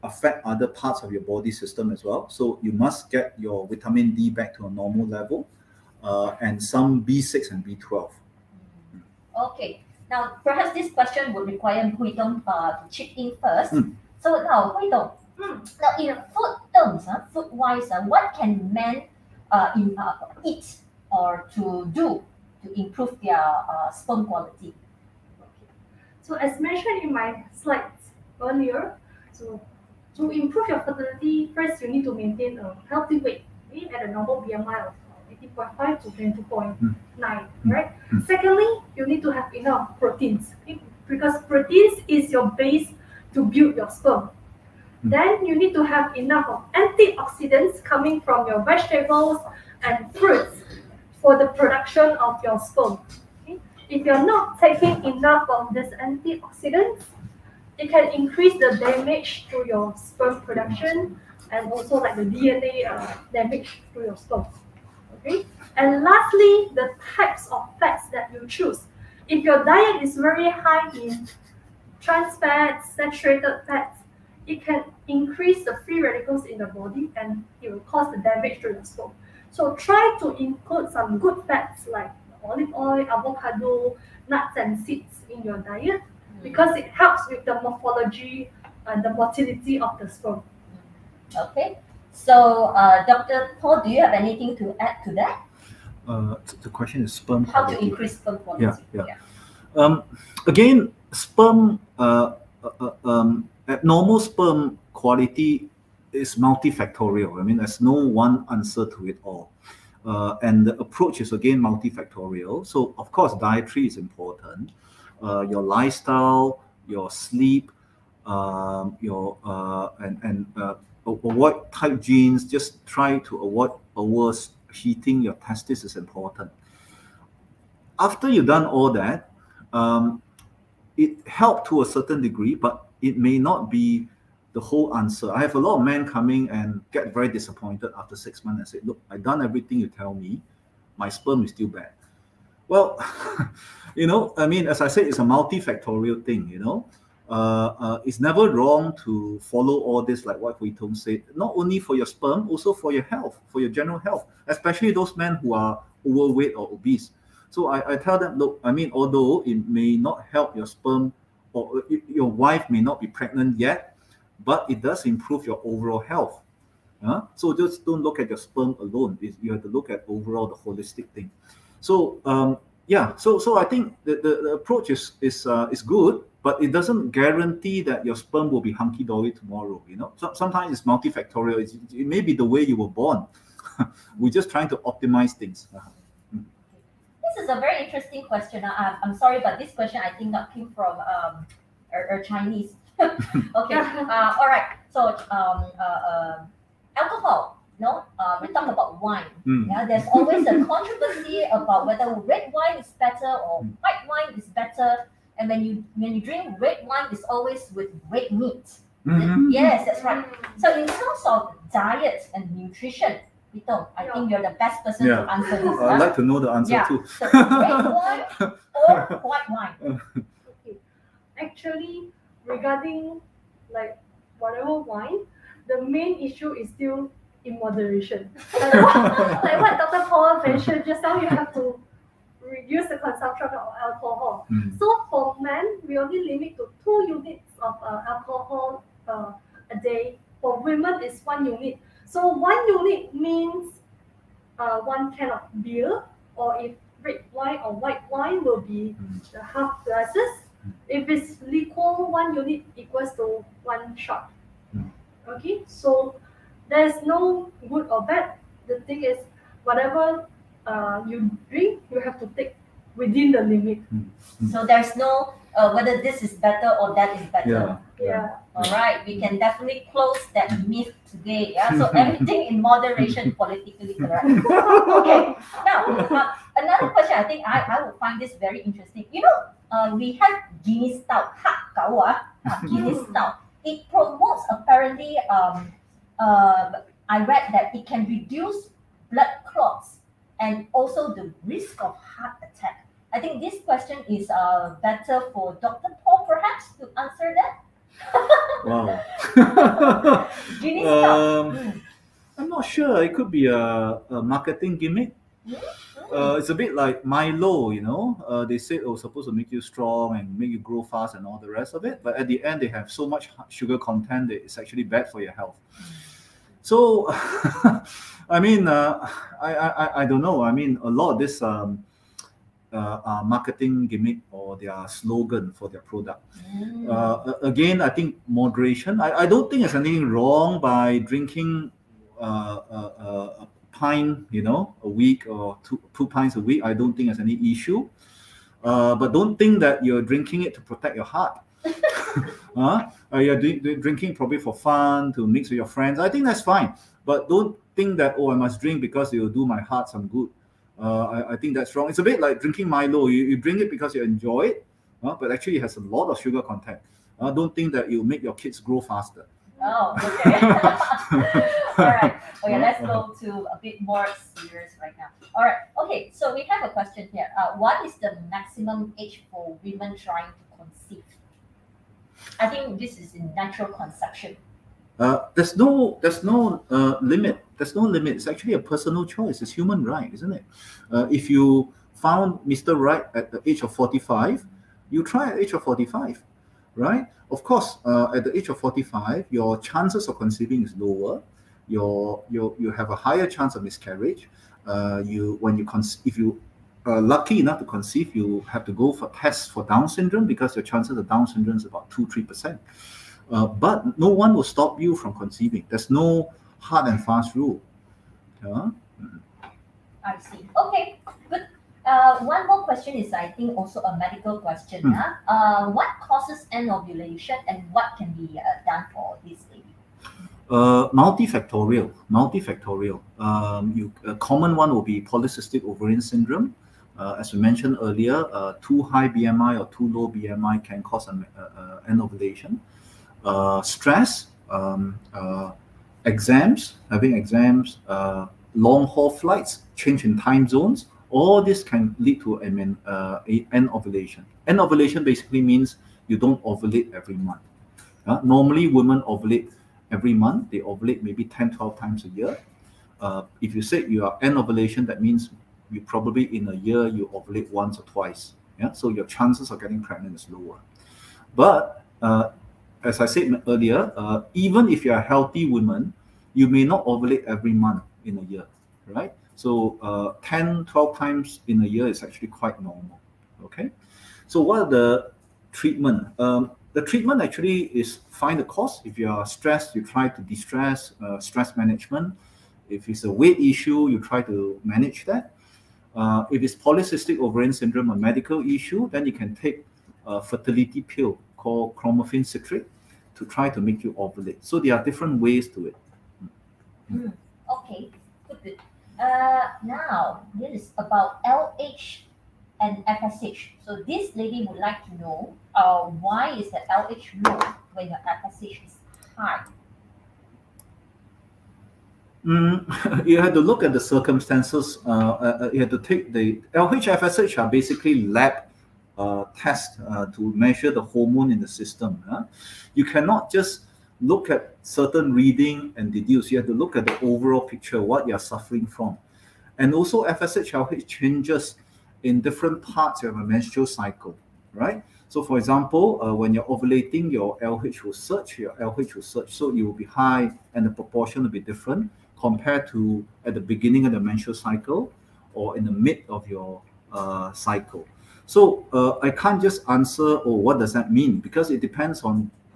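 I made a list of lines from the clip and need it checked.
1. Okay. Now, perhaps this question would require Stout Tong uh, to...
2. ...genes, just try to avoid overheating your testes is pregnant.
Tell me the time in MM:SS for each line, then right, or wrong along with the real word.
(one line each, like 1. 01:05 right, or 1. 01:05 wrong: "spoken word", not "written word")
1. 00:09 wrong: "Hui", not "Stout"
2. 02:02 wrong: "important", not "pregnant".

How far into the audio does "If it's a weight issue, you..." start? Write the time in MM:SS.
08:02.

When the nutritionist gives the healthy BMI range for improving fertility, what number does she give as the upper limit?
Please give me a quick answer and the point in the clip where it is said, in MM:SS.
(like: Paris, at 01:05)
22.9, at 00:36.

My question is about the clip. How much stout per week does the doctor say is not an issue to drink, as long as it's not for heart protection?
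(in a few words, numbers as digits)
2 pints.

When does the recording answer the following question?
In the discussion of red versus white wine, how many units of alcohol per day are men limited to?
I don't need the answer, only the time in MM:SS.
03:56.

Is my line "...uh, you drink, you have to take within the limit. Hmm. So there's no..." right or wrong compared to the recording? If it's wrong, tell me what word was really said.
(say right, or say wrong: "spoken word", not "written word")
right.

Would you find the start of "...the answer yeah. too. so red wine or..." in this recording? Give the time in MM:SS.
03:36.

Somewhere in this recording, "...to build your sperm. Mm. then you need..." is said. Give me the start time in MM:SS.
00:43.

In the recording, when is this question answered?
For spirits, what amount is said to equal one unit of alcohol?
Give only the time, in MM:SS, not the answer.
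04:13.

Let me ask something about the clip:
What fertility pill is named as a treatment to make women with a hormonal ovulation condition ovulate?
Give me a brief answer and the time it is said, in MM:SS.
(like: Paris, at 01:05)
Clomiphene citrate, at 08:11.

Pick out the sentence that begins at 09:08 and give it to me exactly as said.
So uh, I can't just answer, or oh, what does that mean?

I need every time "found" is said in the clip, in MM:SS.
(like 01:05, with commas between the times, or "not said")
06:21.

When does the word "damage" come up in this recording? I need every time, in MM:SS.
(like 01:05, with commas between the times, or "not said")
00:58, 01:03, 01:18.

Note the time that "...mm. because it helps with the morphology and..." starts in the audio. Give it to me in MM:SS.
01:26.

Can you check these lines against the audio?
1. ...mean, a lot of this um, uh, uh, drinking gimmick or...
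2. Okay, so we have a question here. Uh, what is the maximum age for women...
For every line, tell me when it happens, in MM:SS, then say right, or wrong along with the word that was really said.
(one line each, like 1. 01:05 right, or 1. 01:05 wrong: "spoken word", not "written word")
1. 05:20 wrong: "marketing", not "drinking"
2. 06:05 right.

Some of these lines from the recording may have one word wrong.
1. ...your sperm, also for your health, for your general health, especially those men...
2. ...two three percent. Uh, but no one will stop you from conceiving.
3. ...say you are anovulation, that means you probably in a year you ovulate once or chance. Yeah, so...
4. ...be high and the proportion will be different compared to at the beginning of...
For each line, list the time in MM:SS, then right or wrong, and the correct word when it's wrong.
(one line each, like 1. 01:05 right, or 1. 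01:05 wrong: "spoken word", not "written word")
1. 02:31 right
2. 06:41 right
3. 07:33 wrong: "twice", not "chance"
4. 08:59 right.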